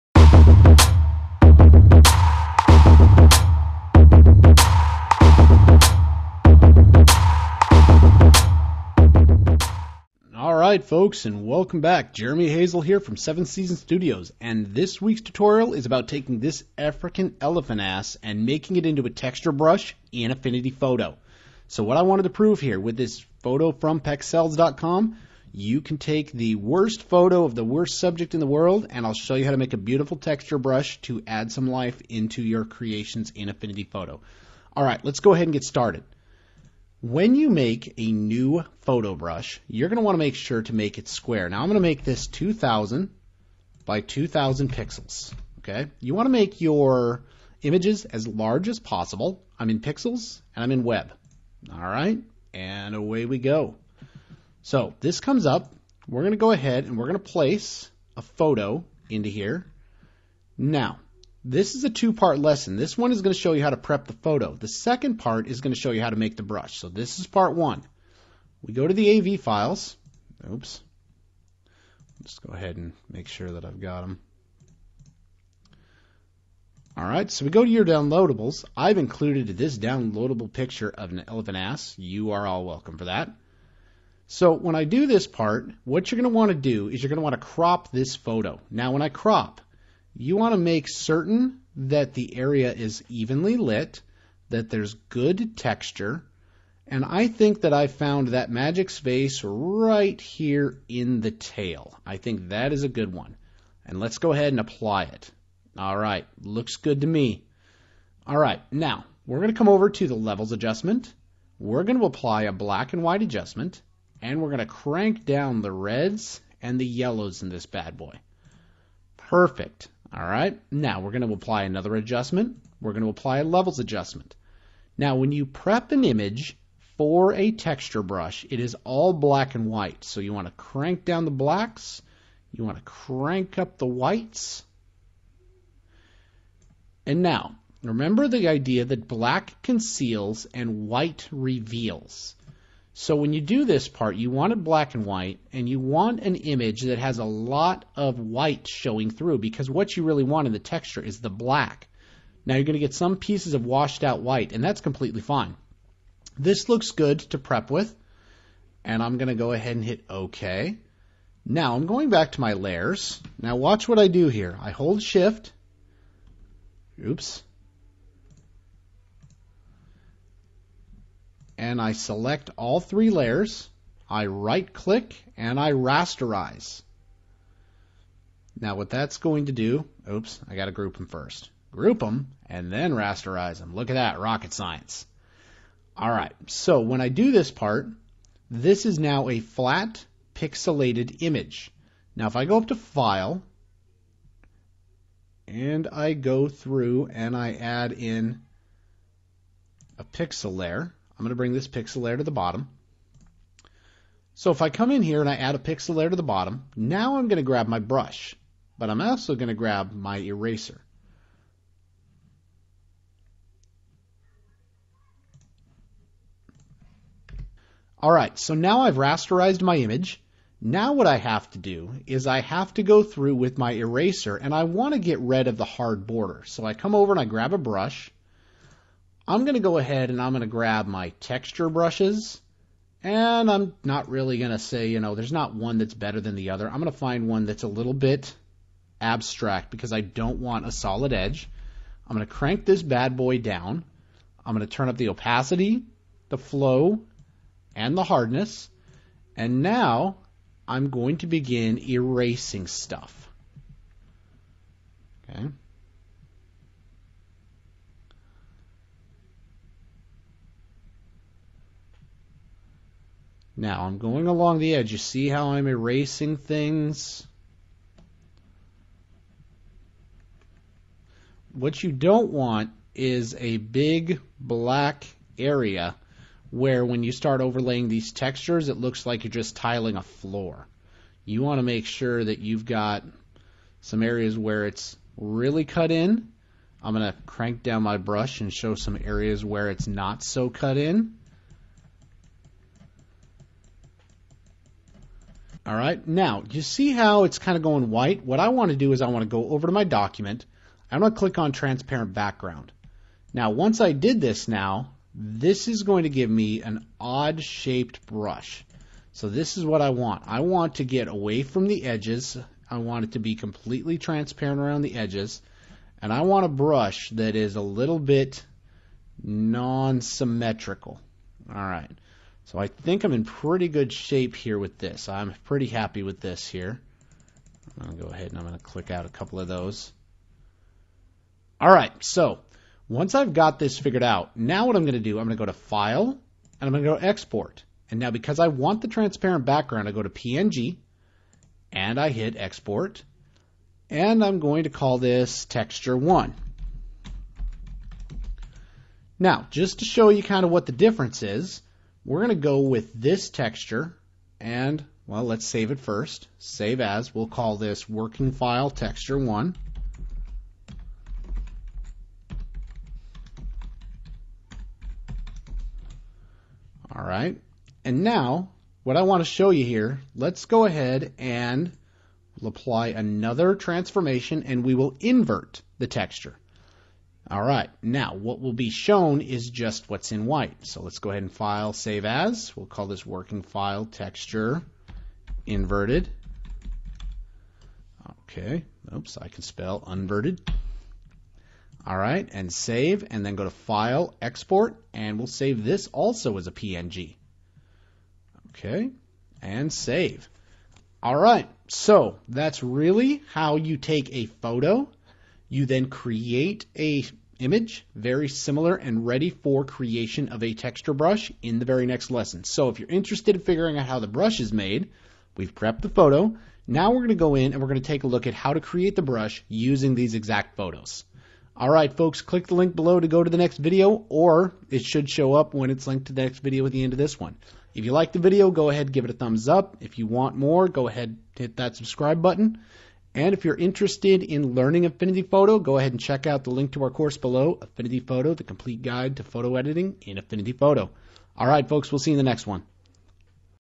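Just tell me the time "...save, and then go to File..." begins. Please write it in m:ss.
6:32.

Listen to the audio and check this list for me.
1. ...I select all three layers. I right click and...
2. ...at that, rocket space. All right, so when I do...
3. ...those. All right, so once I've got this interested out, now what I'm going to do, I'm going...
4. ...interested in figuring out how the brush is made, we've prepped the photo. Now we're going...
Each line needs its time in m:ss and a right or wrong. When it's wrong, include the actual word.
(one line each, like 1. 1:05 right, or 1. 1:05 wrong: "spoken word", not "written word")
1. 2:51 right
2. 3:03 wrong: "science", not "space"
3. 5:29 wrong: "figured", not "interested"
4. 6:52 right.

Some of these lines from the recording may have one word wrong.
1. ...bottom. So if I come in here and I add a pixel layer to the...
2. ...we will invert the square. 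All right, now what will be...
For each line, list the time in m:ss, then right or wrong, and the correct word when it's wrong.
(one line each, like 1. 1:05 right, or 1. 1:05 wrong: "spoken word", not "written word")
1. 3:22 right
2. 6:14 wrong: "texture", not "square".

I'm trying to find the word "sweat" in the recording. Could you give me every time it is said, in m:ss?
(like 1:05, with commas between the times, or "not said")
not said.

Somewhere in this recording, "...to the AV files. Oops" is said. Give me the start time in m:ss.
1:08.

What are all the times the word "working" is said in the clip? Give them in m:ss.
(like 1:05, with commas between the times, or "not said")
5:57, 6:23.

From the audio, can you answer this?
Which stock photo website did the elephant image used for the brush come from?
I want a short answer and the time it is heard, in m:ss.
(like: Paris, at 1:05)
Pexels.com, at 0:23.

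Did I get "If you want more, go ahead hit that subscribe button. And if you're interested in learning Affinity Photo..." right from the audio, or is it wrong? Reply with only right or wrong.
right.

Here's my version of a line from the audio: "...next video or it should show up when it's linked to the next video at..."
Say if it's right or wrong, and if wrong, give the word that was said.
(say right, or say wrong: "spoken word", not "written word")
right.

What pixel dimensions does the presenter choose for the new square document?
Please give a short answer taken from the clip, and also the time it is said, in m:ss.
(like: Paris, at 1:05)
2000 by 2000, at 0:42.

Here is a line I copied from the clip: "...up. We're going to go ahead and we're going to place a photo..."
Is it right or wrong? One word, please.
right.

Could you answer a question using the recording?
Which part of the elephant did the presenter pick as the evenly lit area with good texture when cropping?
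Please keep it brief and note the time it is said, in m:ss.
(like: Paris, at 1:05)
the tail, at 1:41.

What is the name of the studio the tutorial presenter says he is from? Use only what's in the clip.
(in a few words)
Seventh Season Studios.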